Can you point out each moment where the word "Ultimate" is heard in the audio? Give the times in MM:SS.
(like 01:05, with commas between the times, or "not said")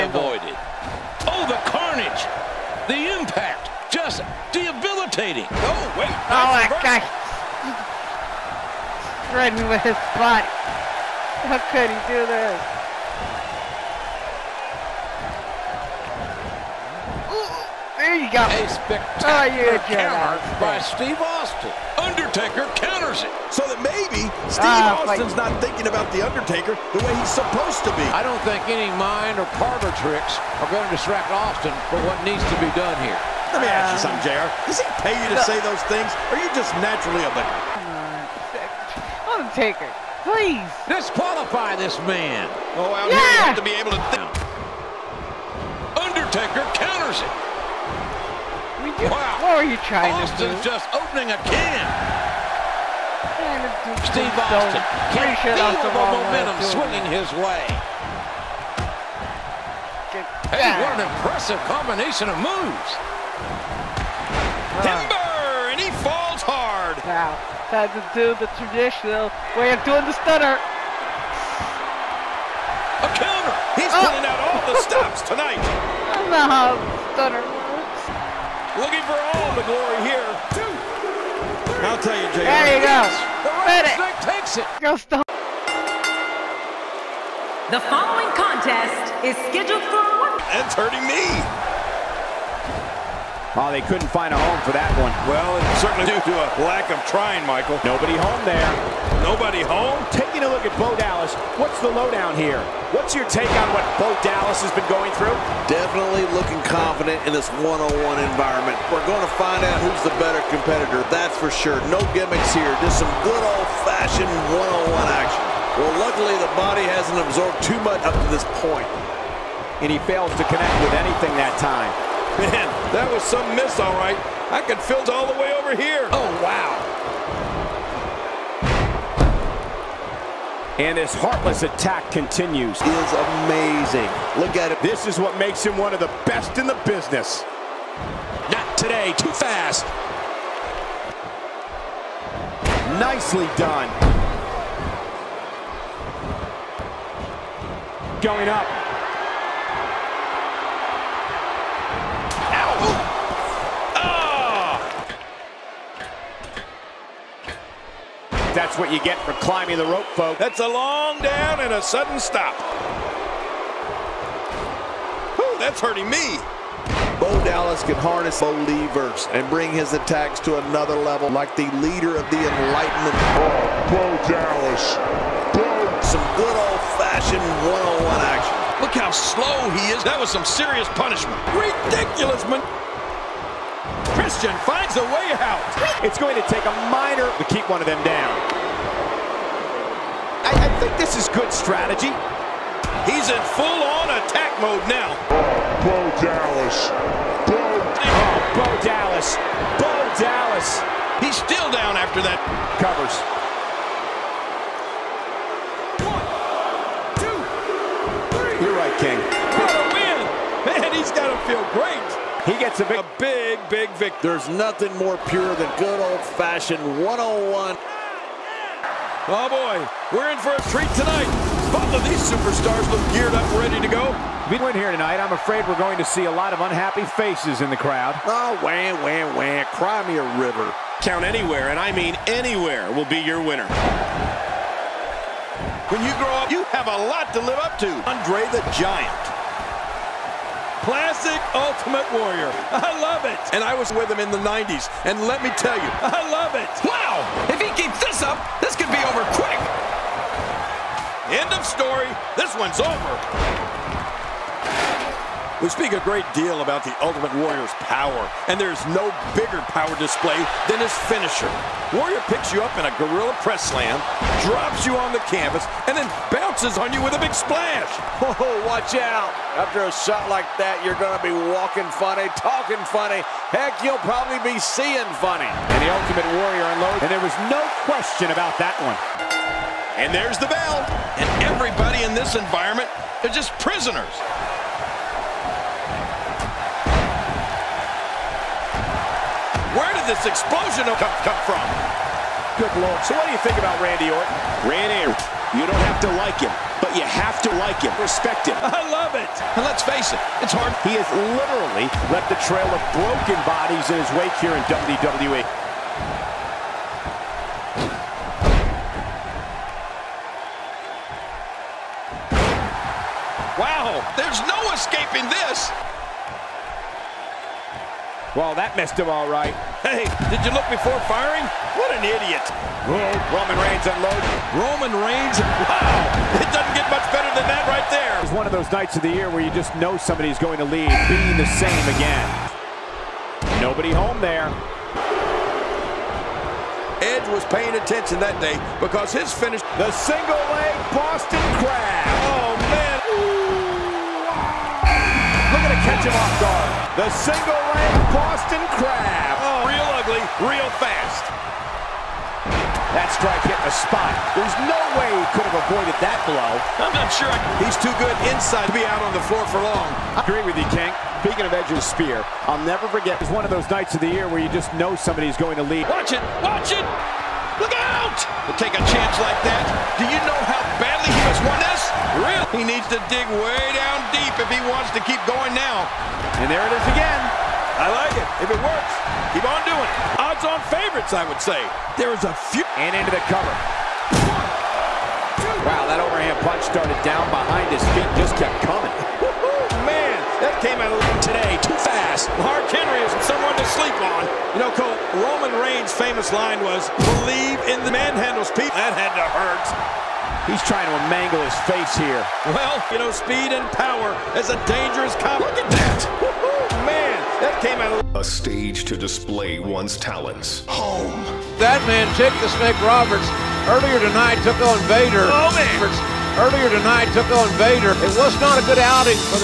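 04:01, 04:17, 04:35.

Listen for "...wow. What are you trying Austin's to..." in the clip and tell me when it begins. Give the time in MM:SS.
00:49.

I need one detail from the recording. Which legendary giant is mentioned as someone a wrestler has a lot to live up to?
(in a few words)
Andre the Giant.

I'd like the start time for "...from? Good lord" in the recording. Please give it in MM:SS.
04:51.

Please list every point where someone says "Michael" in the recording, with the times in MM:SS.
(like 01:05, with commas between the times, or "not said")
01:37.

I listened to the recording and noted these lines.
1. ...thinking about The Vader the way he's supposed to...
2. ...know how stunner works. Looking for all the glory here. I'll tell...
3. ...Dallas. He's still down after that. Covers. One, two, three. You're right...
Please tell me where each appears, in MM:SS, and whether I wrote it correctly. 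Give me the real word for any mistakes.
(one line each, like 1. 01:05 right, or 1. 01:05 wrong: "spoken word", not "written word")
1. 00:25 wrong: "Undertaker", not "Vader"
2. 01:16 right
3. 03:20 right.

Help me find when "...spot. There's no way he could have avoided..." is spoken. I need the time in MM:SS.
05:53.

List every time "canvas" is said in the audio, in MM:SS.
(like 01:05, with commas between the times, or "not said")
04:25.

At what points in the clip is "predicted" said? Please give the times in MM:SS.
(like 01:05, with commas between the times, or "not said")
not said.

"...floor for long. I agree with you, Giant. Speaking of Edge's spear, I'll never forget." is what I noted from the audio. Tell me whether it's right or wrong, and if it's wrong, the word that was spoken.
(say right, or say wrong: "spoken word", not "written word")
wrong: "King", not "Giant".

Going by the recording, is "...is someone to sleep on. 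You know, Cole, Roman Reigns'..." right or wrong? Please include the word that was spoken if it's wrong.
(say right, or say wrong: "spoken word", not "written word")
right.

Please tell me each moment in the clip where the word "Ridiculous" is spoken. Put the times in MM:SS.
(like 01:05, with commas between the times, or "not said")
03:01.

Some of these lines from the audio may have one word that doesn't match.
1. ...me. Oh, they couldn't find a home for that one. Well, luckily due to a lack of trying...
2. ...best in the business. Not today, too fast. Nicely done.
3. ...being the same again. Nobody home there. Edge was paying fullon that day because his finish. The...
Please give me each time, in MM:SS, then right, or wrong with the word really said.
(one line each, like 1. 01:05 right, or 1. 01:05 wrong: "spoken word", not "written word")
1. 01:31 wrong: "certainly", not "luckily"
2. 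02:16 right
3. 05:31 wrong: "attention", not "fullon".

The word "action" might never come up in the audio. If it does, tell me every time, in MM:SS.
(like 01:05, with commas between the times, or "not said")
01:55, 02:58.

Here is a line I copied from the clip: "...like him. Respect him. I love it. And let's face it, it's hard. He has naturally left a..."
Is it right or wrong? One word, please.
wrong.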